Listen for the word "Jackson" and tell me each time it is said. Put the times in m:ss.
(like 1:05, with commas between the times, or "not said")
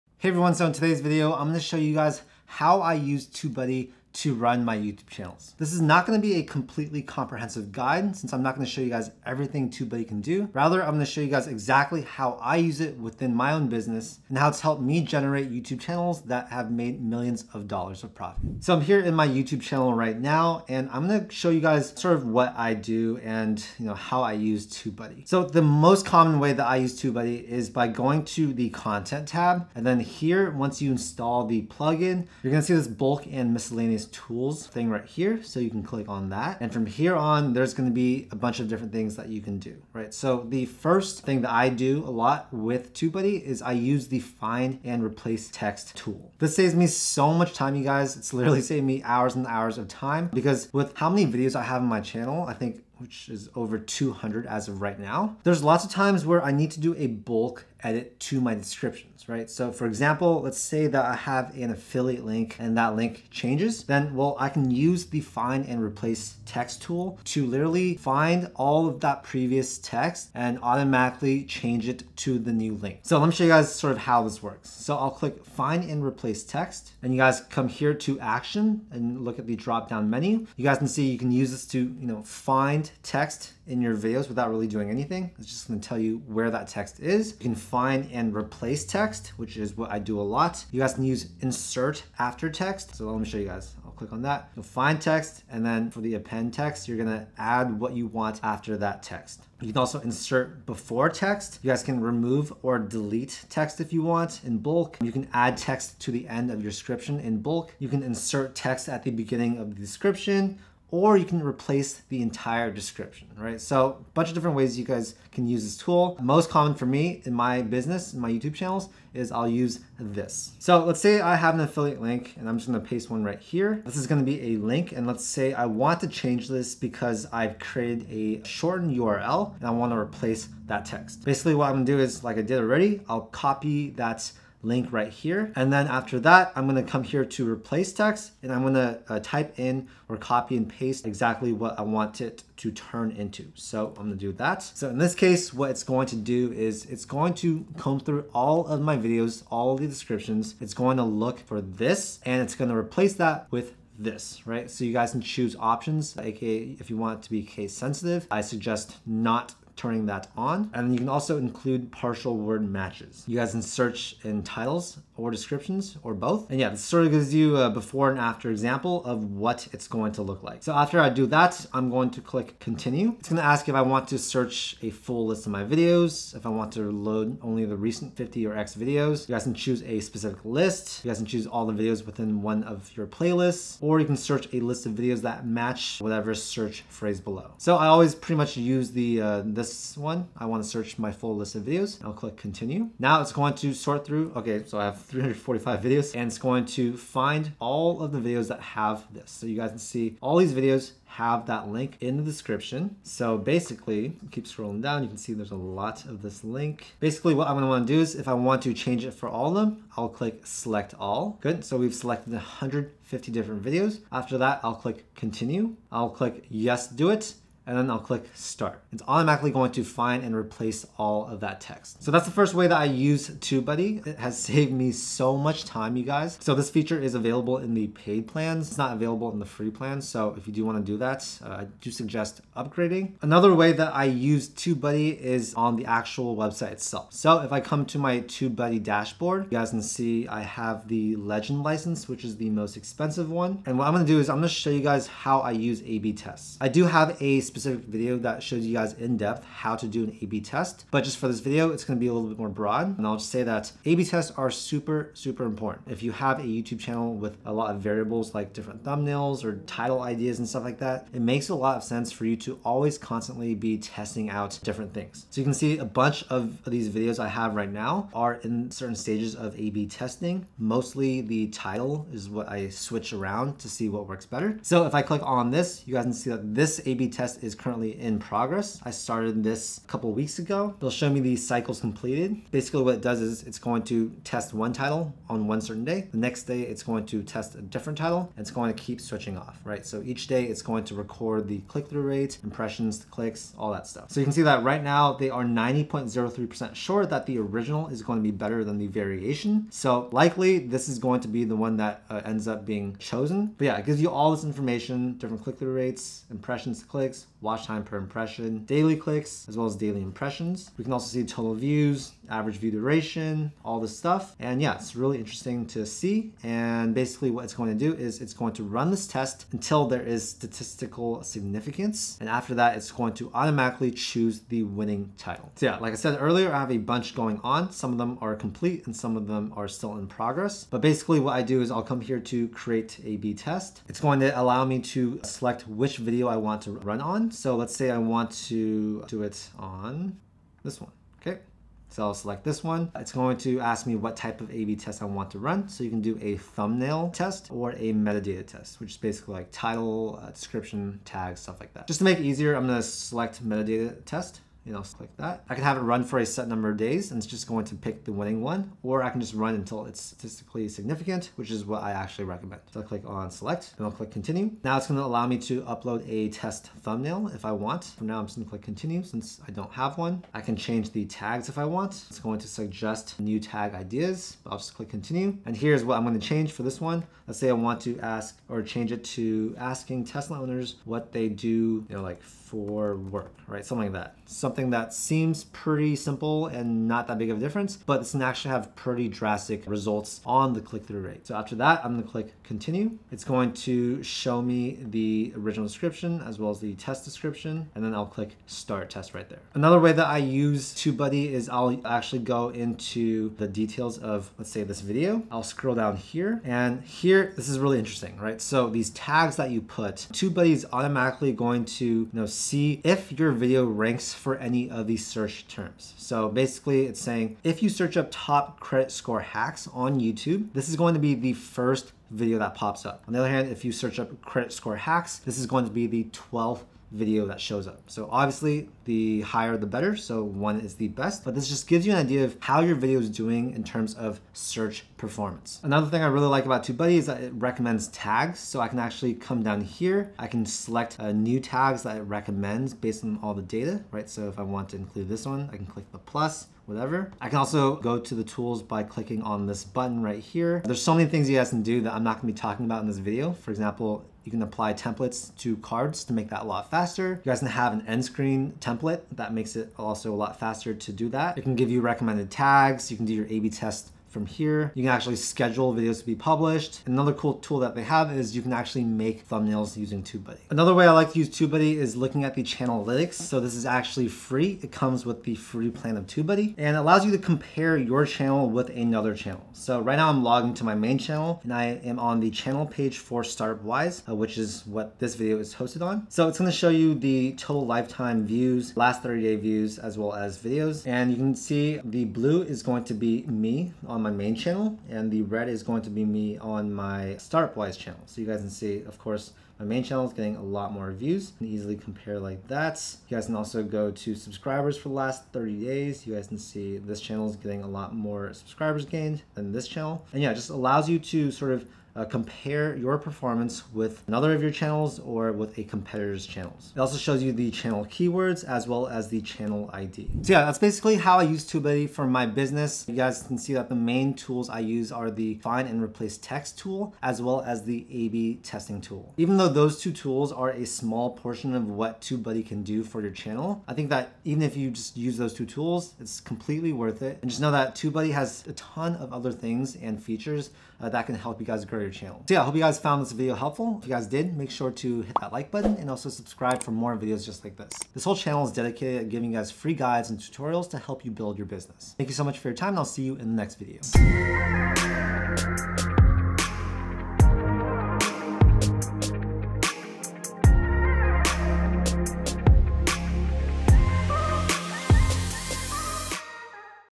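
not said.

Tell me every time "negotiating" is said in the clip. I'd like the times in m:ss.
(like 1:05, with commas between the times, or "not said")
not said.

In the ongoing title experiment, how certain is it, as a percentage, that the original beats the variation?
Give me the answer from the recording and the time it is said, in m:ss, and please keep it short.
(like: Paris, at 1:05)
90.03%, at 4:55.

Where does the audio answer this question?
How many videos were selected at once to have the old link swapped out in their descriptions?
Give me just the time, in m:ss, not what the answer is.
3:32.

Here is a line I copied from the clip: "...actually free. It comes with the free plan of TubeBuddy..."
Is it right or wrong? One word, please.
right.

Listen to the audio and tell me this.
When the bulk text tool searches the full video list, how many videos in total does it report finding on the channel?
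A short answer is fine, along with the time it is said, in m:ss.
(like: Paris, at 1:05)
345, at 3:15.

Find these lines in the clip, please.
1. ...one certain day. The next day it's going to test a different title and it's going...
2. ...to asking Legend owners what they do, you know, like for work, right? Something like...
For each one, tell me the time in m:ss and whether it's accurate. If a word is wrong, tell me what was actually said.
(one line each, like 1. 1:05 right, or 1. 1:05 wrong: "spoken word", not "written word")
1. 4:45 right
2. 6:19 wrong: "Tesla", not "Legend".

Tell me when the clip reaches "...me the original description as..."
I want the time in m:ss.
6:34.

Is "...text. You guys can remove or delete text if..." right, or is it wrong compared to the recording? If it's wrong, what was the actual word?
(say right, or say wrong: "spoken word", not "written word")
right.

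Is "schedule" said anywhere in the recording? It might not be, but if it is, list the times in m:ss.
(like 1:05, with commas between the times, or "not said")
7:45.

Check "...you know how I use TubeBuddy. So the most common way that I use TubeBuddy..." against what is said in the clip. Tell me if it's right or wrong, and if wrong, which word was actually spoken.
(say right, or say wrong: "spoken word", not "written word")
right.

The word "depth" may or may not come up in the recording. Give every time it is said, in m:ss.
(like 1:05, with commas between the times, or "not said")
4:09.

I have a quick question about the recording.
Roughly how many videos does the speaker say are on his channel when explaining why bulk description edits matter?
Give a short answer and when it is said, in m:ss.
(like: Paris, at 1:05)
over 200, at 0:53.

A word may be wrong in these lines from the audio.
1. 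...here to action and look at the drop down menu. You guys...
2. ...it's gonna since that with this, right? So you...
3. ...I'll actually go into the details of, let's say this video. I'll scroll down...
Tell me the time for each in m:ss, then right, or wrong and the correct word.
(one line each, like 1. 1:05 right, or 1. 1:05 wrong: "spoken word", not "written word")
1. 1:17 right
2. 2:32 wrong: "replace", not "since"
3. 6:41 right.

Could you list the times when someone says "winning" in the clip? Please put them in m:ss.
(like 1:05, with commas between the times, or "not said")
5:24, 5:58.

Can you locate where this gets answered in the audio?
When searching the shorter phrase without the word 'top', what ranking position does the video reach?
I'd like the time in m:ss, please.
7:06.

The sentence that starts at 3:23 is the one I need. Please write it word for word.
So basically, keep scrolling down, you can see there's a lot of this link.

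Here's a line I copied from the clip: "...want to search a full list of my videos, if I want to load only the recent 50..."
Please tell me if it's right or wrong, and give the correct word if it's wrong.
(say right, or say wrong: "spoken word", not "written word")
right.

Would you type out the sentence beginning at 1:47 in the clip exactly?
You can insert text at the beginning of the description or you can replace the entire description, right?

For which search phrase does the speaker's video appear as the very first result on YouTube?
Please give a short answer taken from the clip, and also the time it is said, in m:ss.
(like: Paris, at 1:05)
top credit score hacks, at 6:58.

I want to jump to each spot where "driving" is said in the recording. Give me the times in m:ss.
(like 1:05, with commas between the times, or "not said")
not said.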